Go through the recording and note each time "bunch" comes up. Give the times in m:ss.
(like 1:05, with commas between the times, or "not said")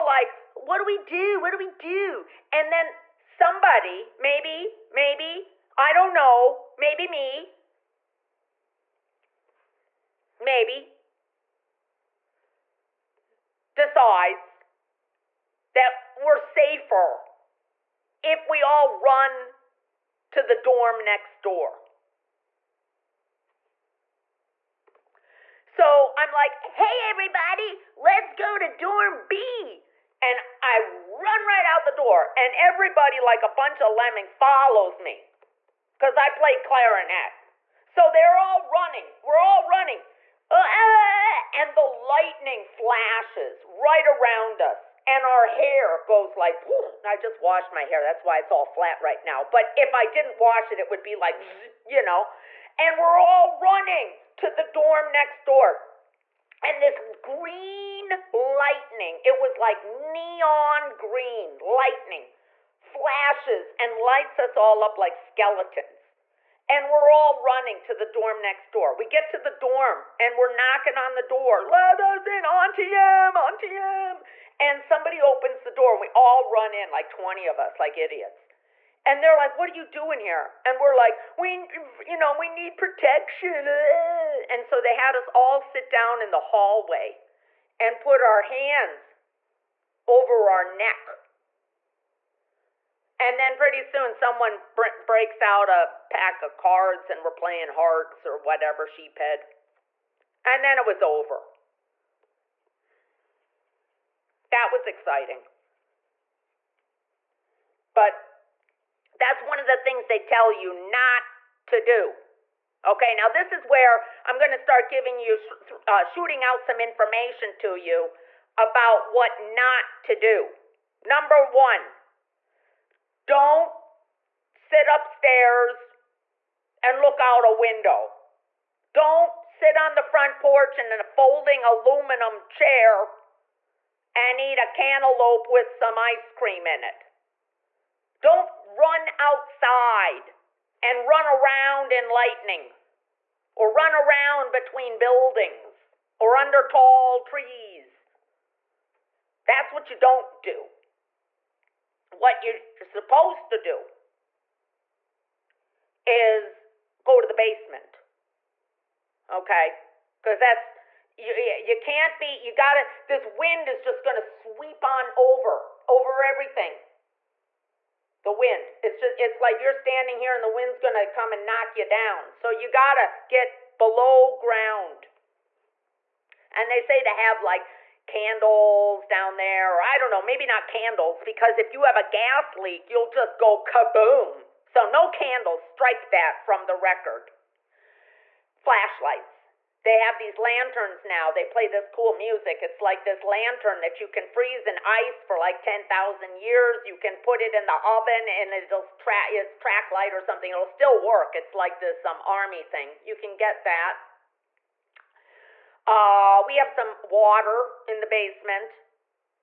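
0:33.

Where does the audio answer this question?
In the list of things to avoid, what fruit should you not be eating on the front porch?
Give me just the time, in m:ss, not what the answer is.
2:14.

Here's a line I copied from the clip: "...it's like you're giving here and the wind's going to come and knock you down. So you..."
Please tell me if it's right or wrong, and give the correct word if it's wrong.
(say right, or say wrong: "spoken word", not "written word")
wrong: "standing", not "giving".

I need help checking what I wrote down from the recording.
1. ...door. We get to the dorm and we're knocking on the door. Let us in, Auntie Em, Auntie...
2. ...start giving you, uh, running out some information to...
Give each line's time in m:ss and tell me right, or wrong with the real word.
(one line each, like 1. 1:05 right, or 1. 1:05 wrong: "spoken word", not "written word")
1. 1:08 right
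2. 1:54 wrong: "shooting", not "running".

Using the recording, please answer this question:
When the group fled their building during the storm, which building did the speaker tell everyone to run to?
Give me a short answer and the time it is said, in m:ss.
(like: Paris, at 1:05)
Dorm B, at 0:28.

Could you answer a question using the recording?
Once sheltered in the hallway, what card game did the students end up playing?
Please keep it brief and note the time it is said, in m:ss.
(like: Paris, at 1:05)
Hearts, at 1:37.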